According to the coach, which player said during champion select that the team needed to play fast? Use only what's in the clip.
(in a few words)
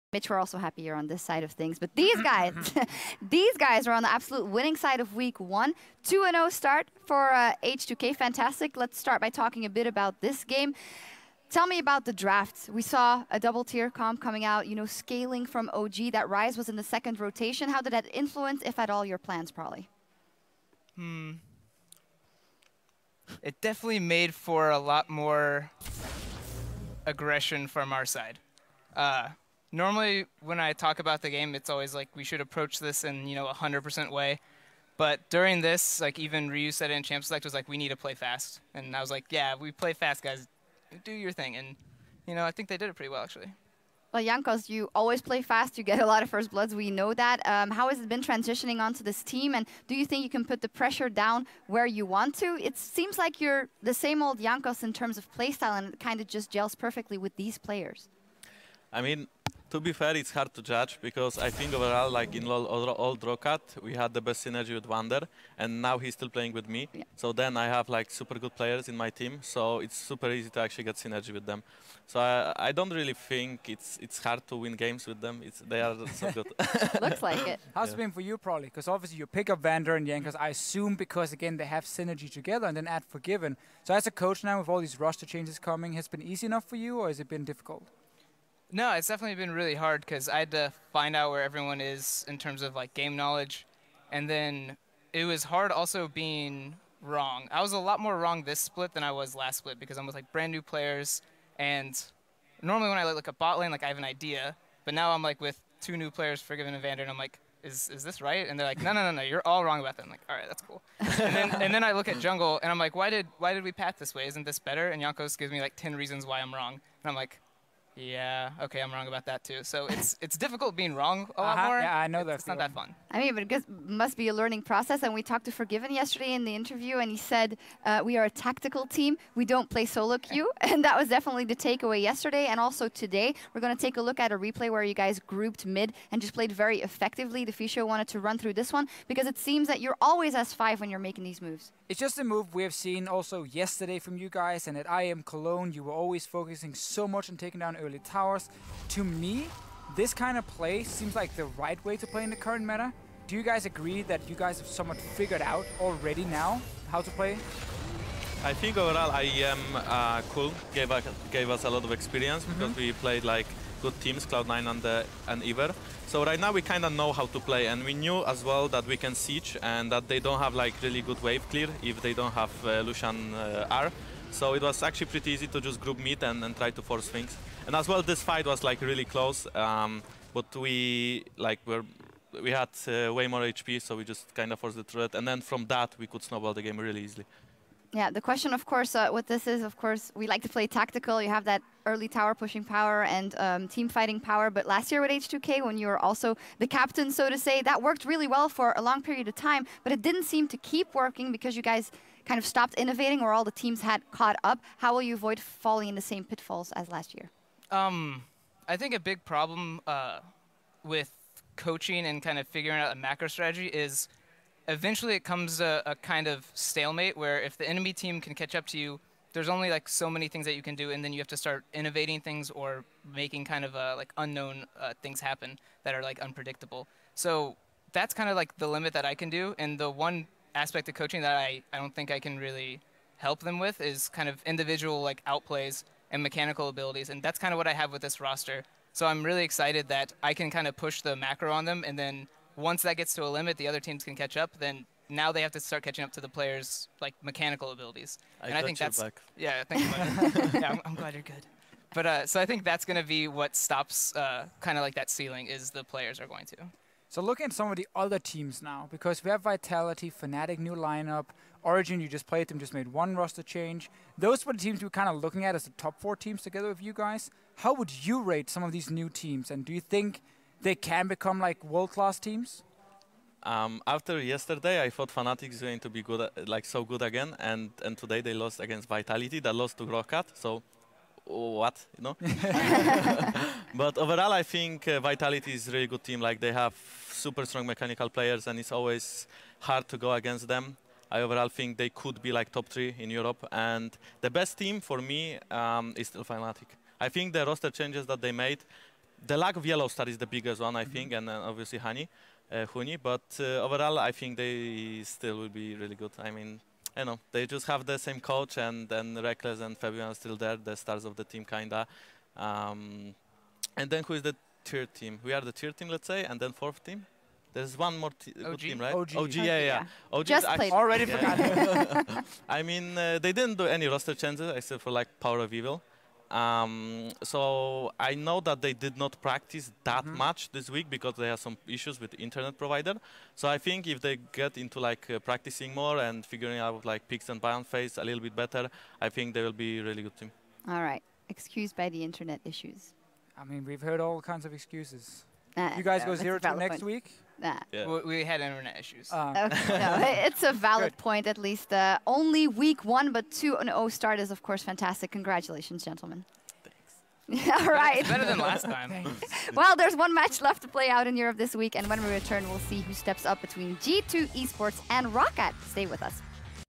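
Ryu.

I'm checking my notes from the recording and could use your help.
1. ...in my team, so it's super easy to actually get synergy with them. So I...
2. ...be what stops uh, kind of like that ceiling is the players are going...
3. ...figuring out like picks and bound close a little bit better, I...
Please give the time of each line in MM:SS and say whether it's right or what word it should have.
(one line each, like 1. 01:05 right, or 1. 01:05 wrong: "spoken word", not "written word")
1. 01:08 right
2. 04:13 right
3. 05:36 wrong: "phase", not "close".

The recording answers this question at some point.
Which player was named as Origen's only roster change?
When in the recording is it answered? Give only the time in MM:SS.
05:25.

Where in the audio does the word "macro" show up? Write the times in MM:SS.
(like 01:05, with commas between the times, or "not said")
03:32, 04:01.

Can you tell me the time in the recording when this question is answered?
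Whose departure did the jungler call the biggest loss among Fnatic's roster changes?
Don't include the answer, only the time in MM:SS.
04:59.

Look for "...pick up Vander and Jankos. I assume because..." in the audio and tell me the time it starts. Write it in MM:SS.
01:19.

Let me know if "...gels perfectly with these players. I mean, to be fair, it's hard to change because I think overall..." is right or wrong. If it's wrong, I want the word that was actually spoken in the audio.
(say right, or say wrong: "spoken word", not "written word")
wrong: "judge", not "change".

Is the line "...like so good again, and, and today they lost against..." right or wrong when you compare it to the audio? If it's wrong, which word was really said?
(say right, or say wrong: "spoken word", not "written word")
right.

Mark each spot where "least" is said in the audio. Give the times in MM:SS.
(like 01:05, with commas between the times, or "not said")
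05:51.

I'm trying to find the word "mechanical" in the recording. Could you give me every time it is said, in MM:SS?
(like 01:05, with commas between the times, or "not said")
03:56, 04:07, 04:47.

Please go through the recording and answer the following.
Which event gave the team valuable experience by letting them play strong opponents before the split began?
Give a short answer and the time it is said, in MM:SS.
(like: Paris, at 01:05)
IEM Cologne, at 02:39.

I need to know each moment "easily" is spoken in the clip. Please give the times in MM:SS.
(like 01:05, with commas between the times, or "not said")
03:07.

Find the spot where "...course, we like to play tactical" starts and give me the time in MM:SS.
03:09.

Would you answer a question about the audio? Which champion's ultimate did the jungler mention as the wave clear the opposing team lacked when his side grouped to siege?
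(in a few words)
Lucian.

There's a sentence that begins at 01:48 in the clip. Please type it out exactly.
And they're like, no, no, no, no, you're all wrong about that.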